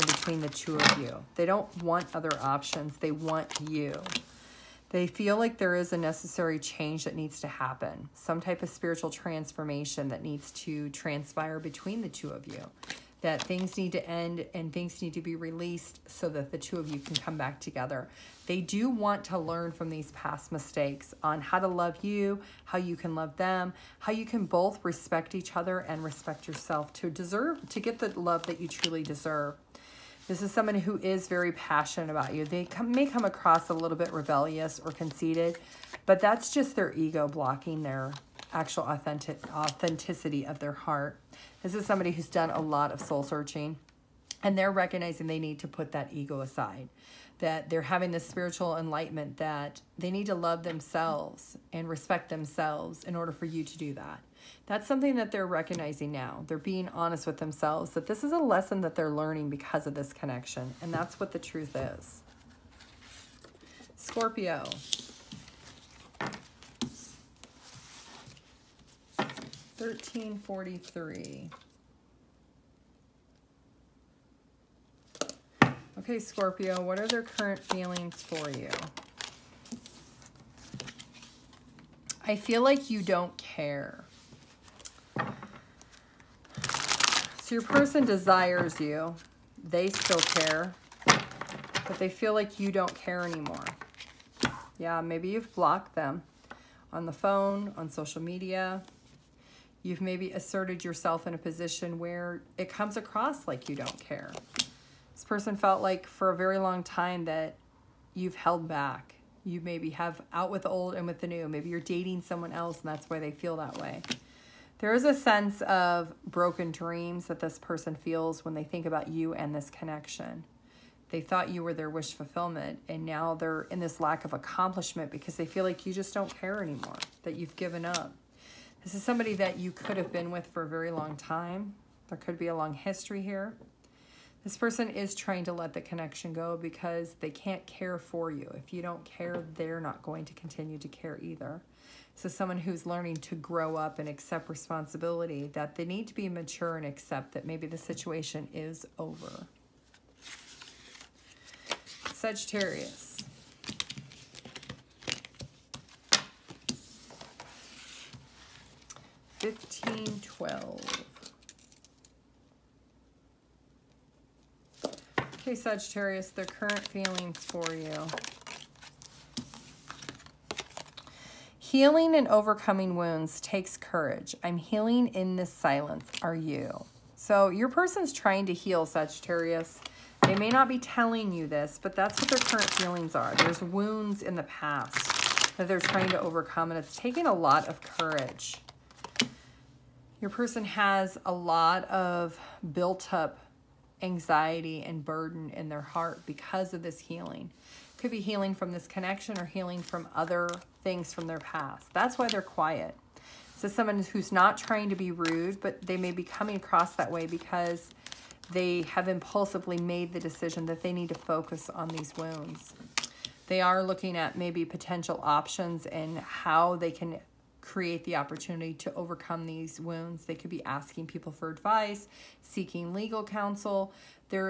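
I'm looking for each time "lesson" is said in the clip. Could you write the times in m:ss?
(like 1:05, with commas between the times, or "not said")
0:58.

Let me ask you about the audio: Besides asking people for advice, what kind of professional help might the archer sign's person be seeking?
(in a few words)
legal counsel.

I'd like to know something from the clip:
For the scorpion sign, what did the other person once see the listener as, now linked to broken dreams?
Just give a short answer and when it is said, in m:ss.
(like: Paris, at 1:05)
wish fulfillment, at 2:01.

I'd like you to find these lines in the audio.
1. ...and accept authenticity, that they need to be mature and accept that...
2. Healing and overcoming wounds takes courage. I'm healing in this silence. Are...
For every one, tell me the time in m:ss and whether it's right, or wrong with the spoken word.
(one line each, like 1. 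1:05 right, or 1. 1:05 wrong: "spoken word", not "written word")
1. 2:23 wrong: "responsibility", not "authenticity"
2. 2:51 right.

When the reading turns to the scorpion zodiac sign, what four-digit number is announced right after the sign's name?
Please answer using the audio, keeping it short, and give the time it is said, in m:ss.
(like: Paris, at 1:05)
1343, at 1:09.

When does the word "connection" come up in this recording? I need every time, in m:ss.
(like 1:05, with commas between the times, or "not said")
1:00, 1:59, 2:15, 3:18.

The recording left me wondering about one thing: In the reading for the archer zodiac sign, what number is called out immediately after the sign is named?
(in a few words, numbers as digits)
1512.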